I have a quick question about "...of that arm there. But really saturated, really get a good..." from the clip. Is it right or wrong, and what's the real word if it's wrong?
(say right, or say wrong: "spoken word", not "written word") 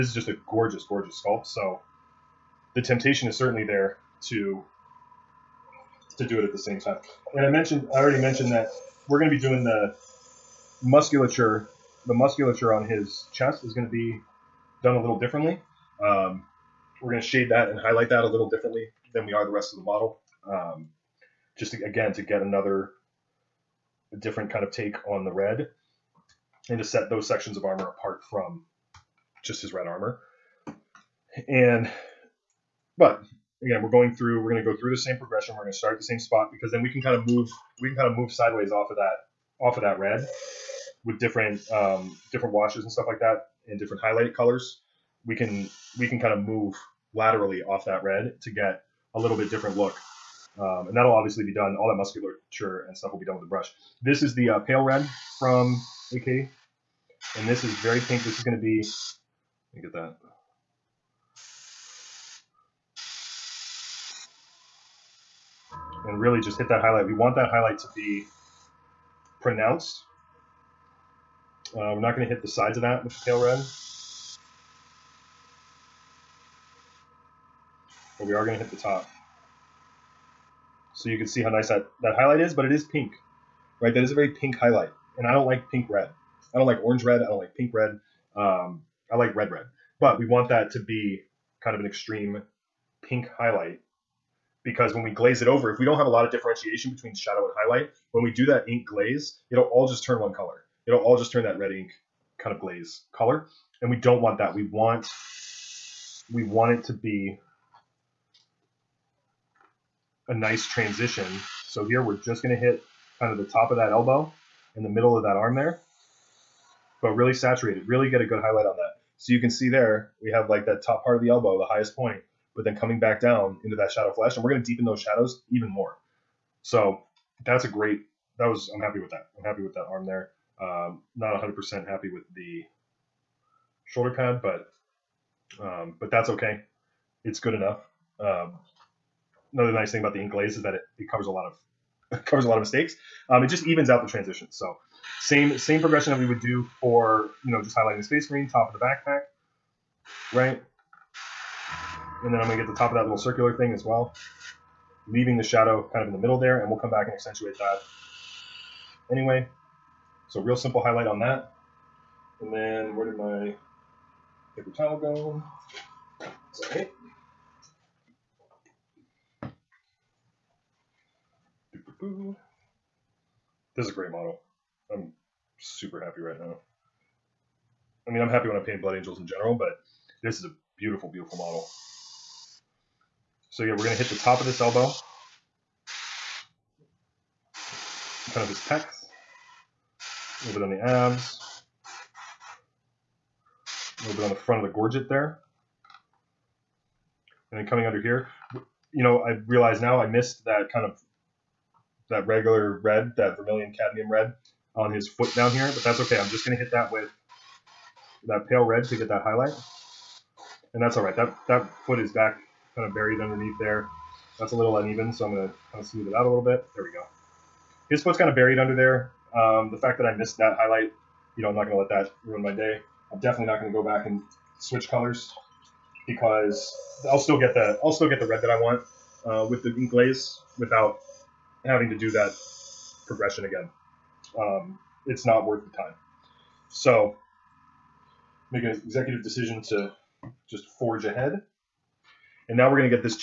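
right.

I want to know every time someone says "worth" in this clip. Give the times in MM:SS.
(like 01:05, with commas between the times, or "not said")
03:55.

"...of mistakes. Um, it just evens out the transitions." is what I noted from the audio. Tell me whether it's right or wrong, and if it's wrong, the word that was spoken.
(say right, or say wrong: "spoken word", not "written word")
right.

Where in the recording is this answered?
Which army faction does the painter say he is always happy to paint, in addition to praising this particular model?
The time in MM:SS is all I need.
02:58.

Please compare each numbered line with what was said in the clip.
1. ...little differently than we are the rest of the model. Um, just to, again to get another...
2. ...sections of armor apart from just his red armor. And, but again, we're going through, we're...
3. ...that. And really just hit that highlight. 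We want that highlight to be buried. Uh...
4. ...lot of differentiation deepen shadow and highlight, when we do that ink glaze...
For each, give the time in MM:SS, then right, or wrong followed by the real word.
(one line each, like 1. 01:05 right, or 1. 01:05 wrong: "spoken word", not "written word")
1. 00:18 right
2. 00:27 right
3. 00:59 wrong: "pronounced", not "buried"
4. 01:36 wrong: "between", not "deepen".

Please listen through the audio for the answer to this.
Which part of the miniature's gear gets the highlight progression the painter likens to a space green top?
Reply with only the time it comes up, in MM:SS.
02:28.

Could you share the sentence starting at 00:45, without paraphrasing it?
We can, we can kind of move laterally off that red to get a little bit different look.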